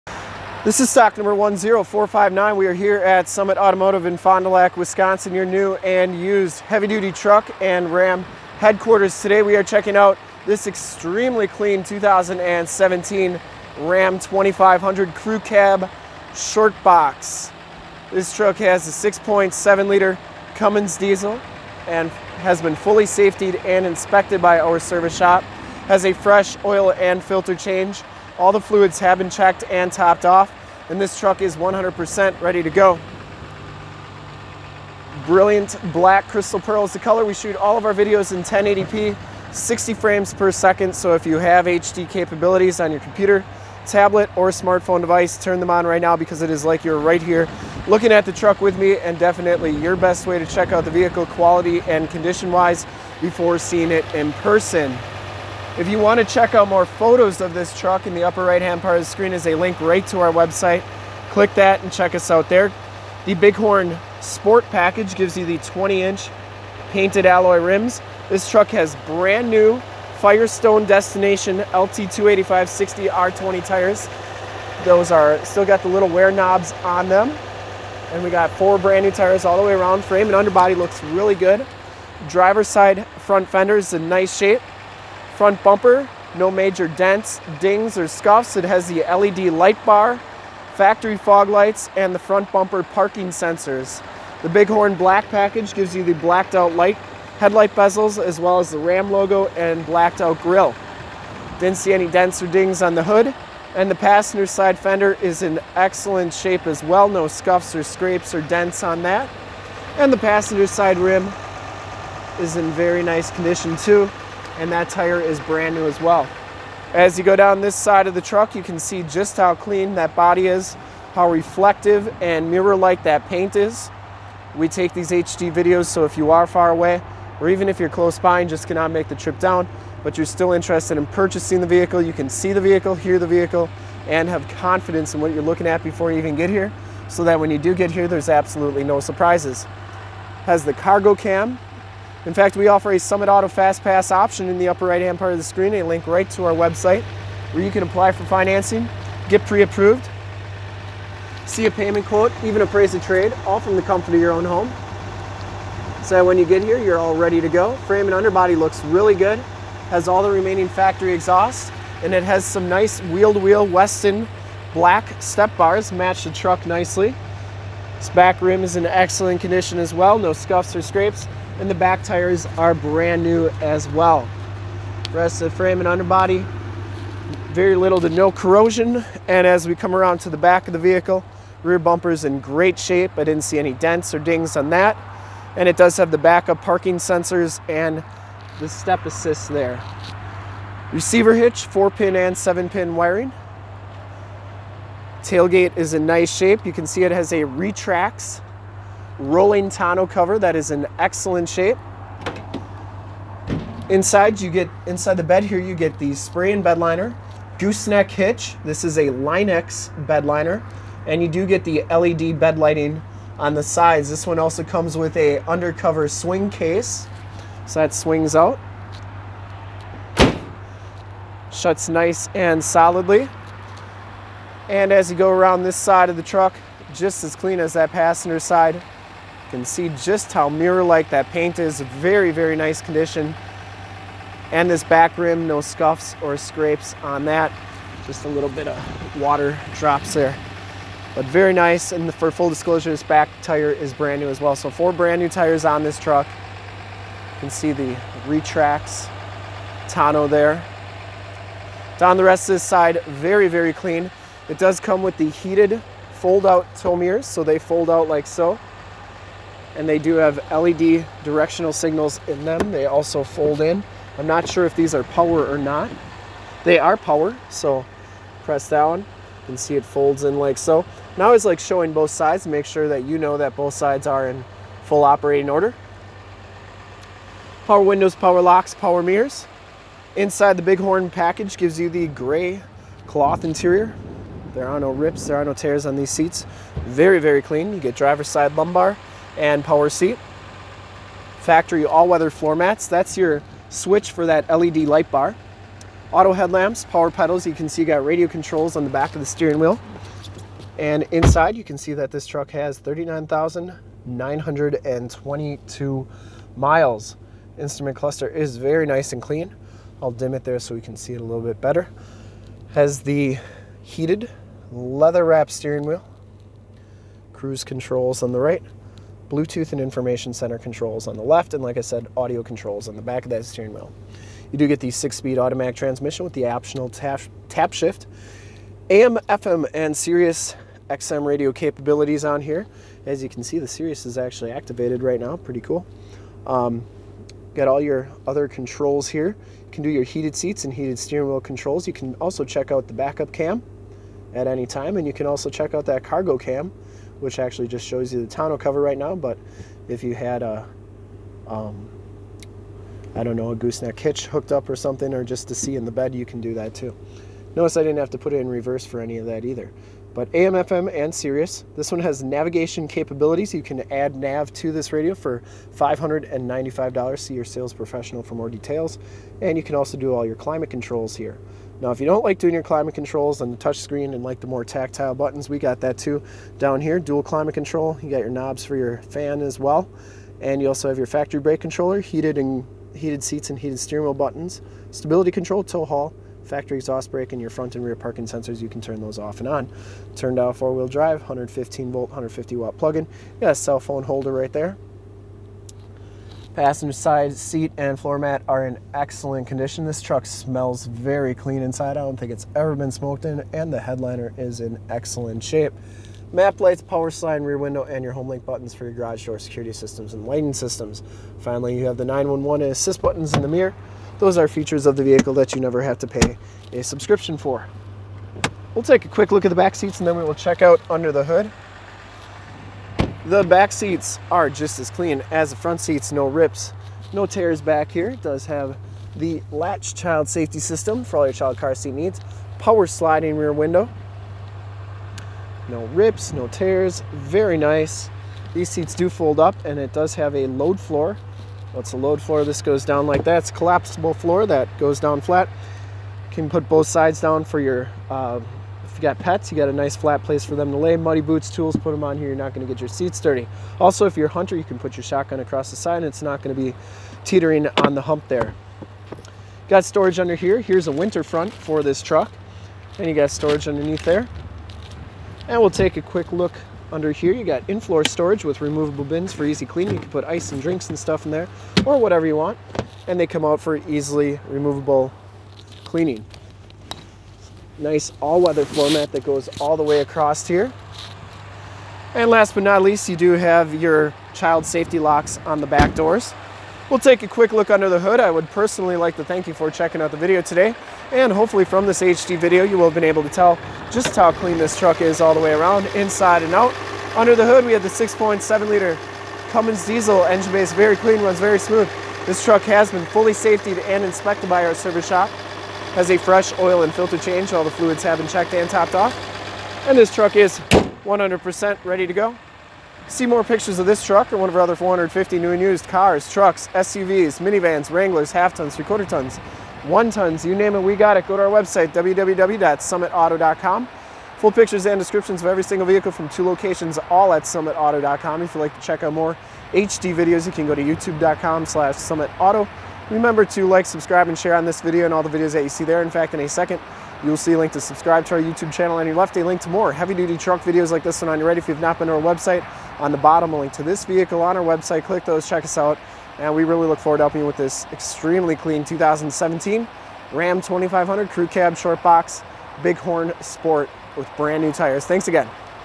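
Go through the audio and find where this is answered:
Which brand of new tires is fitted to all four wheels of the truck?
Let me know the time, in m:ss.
1:10.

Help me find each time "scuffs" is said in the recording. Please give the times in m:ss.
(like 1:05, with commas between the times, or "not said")
1:28, 1:47, 2:50, 3:55.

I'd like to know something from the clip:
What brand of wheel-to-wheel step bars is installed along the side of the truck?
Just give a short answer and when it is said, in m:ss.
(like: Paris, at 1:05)
Westin, at 2:43.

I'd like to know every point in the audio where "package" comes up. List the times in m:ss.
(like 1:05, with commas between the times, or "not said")
1:04, 1:35, 4:41.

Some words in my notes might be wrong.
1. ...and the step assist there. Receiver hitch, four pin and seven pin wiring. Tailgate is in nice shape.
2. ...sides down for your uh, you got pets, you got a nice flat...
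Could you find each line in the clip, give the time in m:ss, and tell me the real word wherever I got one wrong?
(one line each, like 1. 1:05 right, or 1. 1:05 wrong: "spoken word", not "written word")
1. 3:07 right
2. 7:26 right.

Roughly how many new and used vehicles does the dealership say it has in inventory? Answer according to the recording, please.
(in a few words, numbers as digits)
450.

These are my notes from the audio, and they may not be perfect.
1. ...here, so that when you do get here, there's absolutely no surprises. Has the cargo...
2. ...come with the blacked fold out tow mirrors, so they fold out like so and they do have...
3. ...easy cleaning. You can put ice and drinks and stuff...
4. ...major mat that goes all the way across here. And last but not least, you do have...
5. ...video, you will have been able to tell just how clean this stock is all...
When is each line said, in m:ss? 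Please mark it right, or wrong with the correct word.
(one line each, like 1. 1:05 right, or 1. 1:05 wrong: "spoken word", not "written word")
1. 2:16 right
2. 4:14 wrong: "heated", not "blacked"
3. 7:49 right
4. 7:58 wrong: "floor", not "major"
5. 8:12 wrong: "truck", not "stock".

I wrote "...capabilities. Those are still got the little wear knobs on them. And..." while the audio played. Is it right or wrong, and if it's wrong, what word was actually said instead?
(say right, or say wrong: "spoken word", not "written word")
wrong: "tires", not "capabilities".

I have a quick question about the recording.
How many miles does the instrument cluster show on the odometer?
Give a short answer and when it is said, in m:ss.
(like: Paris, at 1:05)
39,922, at 5:02.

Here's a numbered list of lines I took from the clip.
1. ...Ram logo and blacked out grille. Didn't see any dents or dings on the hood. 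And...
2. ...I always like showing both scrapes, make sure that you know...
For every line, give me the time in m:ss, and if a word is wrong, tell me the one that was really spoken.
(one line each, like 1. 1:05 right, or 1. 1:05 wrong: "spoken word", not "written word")
1. 1:38 right
2. 4:31 wrong: "sides", not "scrapes".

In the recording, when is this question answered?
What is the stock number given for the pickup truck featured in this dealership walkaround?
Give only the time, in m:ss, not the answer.
0:01.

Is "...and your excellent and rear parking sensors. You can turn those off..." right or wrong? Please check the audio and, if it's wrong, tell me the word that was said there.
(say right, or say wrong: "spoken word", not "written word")
wrong: "front", not "excellent".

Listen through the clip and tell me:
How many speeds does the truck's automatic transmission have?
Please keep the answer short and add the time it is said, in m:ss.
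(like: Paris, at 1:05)
6, at 5:24.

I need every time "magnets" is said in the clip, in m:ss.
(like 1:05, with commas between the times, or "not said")
not said.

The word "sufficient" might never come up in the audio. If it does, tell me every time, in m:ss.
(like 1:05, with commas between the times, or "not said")
not said.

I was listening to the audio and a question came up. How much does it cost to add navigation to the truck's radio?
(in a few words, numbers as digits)
$595.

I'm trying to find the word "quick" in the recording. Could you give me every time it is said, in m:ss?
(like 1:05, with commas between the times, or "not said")
6:59, 7:46, 8:07.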